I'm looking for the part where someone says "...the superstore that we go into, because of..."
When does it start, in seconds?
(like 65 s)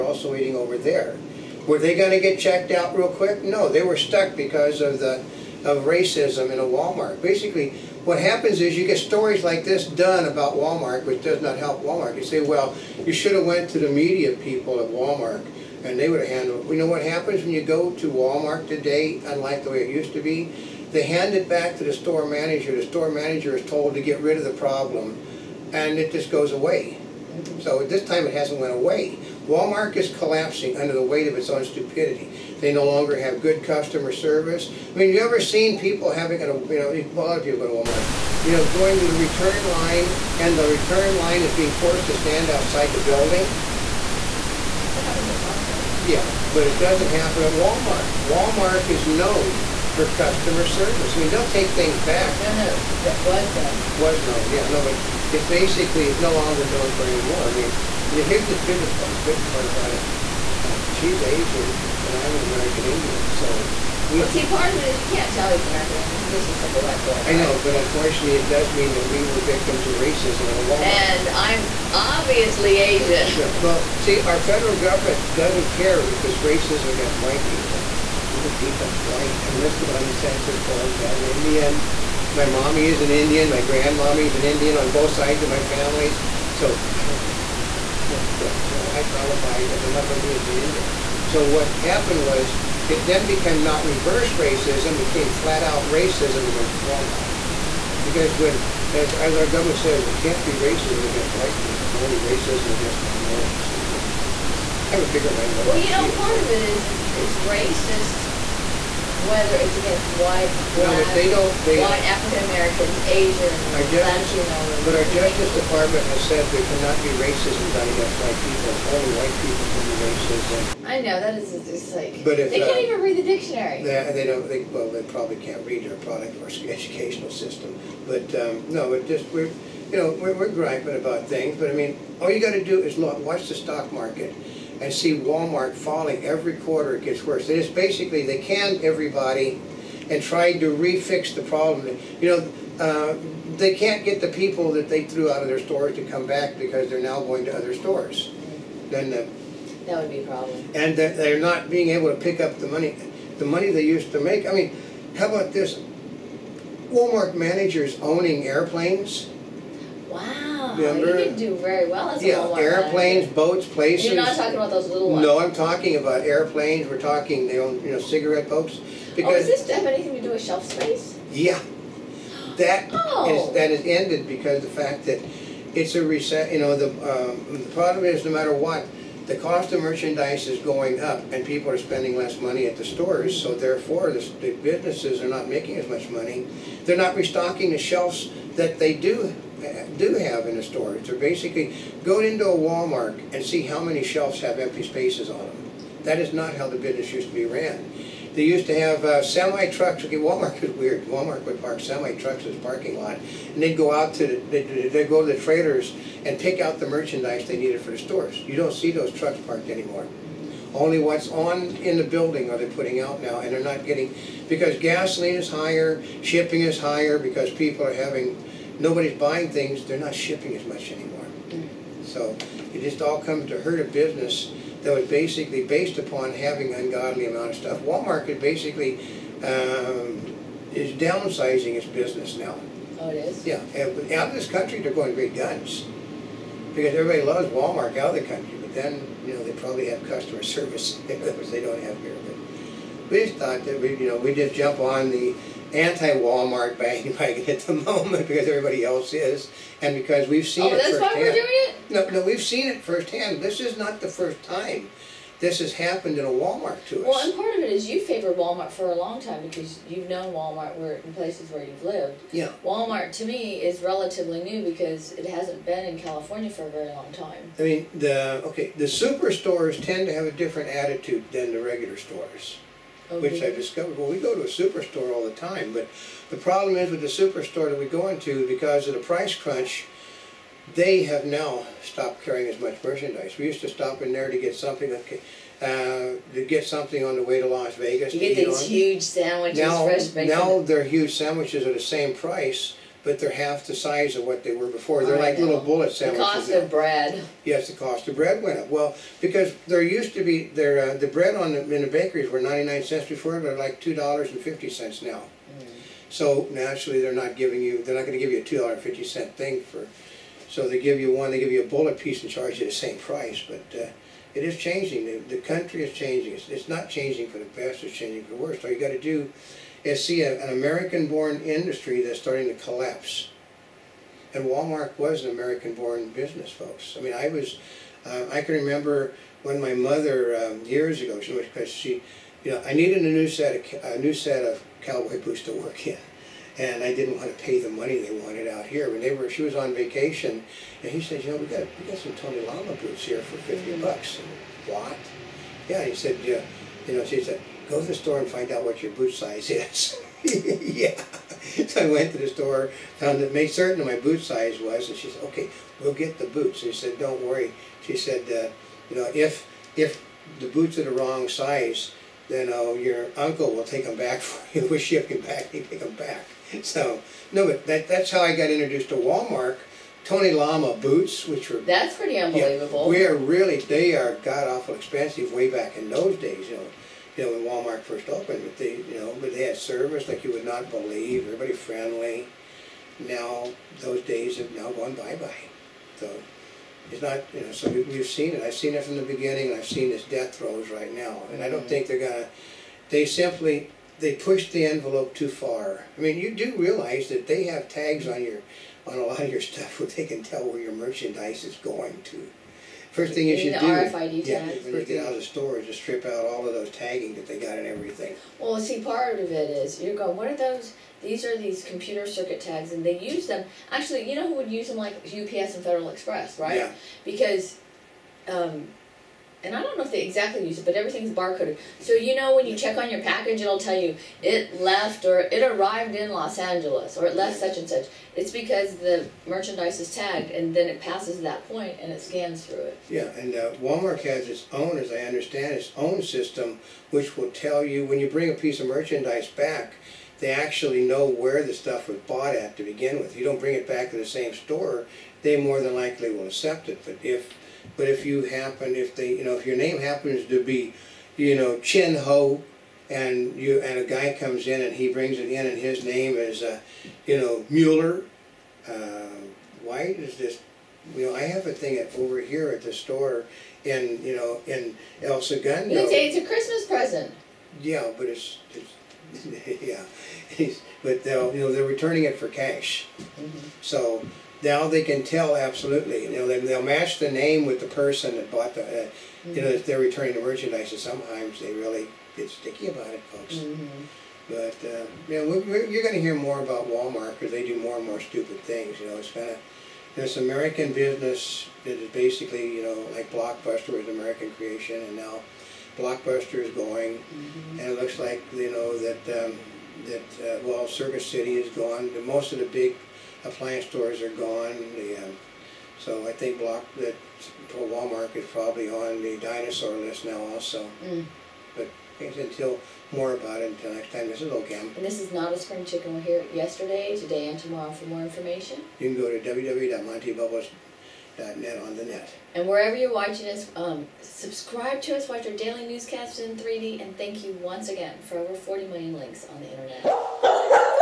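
276 s.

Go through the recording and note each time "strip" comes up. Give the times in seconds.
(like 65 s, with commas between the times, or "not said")
405 s.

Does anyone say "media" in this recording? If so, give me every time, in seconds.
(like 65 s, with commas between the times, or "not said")
13 s.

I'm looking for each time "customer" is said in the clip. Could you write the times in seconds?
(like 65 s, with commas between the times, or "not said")
33 s, 50 s, 240 s.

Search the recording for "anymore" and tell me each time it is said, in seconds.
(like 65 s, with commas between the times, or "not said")
57 s, 209 s, 220 s.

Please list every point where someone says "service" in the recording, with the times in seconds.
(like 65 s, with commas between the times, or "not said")
34 s, 50 s, 240 s, 379 s.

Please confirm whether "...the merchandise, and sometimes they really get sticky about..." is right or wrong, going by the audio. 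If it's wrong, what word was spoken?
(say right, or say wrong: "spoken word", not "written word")
right.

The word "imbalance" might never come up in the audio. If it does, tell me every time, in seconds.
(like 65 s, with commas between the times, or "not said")
not said.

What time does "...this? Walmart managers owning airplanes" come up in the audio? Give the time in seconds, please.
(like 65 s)
155 s.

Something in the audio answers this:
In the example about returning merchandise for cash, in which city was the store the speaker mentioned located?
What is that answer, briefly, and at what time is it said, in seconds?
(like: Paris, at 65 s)
El Segundo, at 465 s.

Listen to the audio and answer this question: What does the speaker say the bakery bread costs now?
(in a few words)
$2.50.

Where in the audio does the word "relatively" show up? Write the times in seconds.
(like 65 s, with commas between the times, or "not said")
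263 s.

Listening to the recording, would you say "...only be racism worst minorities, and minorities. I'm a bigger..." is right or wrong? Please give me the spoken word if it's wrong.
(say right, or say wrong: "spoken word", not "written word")
wrong: "against", not "worst".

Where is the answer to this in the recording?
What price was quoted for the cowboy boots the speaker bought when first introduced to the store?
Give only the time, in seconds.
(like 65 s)
343 s.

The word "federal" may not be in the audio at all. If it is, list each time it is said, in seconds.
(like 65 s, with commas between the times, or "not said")
74 s, 415 s.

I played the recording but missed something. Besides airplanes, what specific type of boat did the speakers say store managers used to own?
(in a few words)
cigarette boats.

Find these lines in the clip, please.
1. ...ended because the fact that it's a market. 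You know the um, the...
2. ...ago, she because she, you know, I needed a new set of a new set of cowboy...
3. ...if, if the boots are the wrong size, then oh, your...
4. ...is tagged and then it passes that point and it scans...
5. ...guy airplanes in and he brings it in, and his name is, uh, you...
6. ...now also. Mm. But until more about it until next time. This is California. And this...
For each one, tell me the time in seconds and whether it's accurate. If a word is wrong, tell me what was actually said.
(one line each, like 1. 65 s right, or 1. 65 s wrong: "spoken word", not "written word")
1. 173 s wrong: "reset", not "market"
2. 330 s right
3. 359 s right
4. 429 s right
5. 453 s wrong: "comes", not "airplanes"
6. 510 s wrong: "Oldecam", not "California".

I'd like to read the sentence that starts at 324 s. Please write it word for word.
And Walmart was an American-born business, folks.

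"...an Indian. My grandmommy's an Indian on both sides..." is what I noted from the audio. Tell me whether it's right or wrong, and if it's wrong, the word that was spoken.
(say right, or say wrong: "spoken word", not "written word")
right.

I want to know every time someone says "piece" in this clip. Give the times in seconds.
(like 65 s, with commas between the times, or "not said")
311 s, 438 s.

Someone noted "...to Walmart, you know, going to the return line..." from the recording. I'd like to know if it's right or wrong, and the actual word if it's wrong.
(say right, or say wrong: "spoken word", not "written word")
right.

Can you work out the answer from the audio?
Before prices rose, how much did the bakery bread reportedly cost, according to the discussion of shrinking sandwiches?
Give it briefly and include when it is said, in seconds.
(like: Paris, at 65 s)
99 cents, at 302 s.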